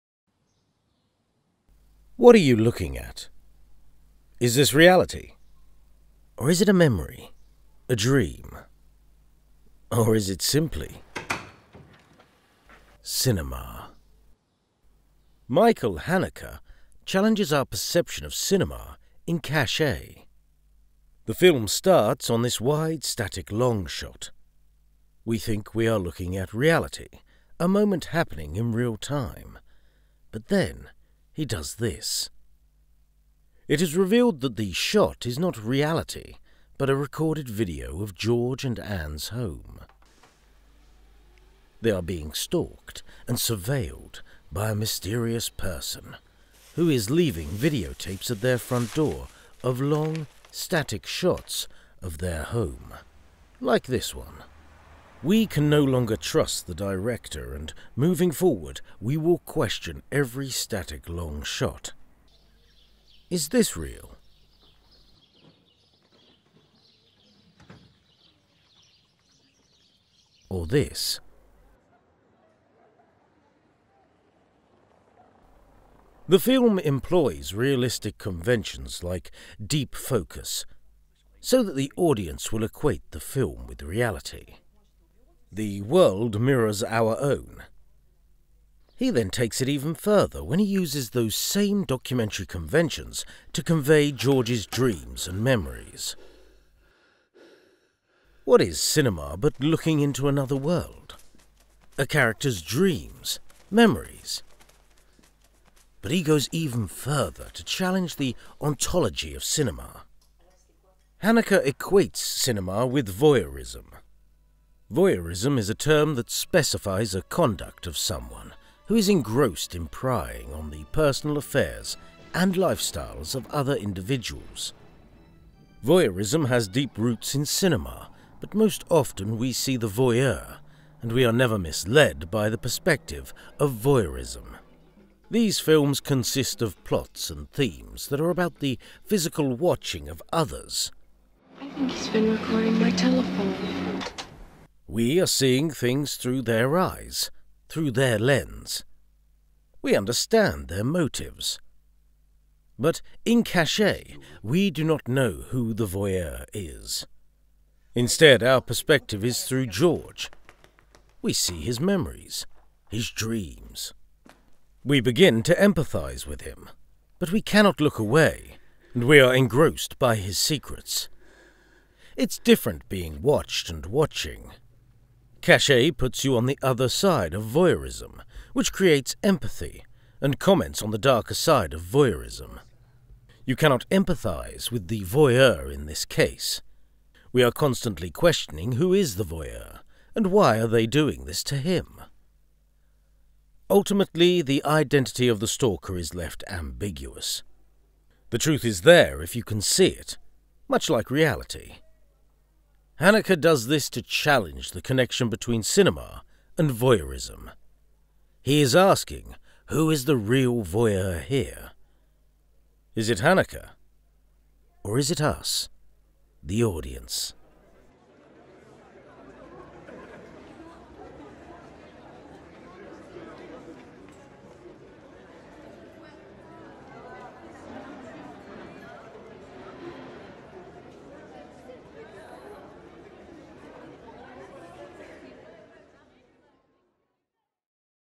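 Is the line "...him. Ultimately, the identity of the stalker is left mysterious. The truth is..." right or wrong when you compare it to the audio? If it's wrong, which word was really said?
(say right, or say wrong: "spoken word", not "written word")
wrong: "ambiguous", not "mysterious".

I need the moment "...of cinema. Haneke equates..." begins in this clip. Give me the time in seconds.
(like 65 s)
109 s.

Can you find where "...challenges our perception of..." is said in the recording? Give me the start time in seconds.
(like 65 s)
17 s.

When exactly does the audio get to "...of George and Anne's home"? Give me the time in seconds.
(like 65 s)
38 s.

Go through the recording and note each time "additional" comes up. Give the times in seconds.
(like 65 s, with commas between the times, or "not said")
not said.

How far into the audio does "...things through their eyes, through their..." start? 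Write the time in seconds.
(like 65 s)
145 s.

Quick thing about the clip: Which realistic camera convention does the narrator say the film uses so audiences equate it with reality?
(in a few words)
deep focus.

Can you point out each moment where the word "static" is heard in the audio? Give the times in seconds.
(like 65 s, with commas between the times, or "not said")
23 s, 50 s, 60 s.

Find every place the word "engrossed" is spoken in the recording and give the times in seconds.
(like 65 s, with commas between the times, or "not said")
119 s, 169 s.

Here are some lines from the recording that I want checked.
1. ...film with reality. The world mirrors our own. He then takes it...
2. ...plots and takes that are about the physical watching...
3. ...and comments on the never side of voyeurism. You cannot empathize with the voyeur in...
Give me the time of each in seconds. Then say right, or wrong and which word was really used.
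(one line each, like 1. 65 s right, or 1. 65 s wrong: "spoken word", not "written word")
1. 83 s right
2. 136 s wrong: "themes", not "takes"
3. 180 s wrong: "darker", not "never".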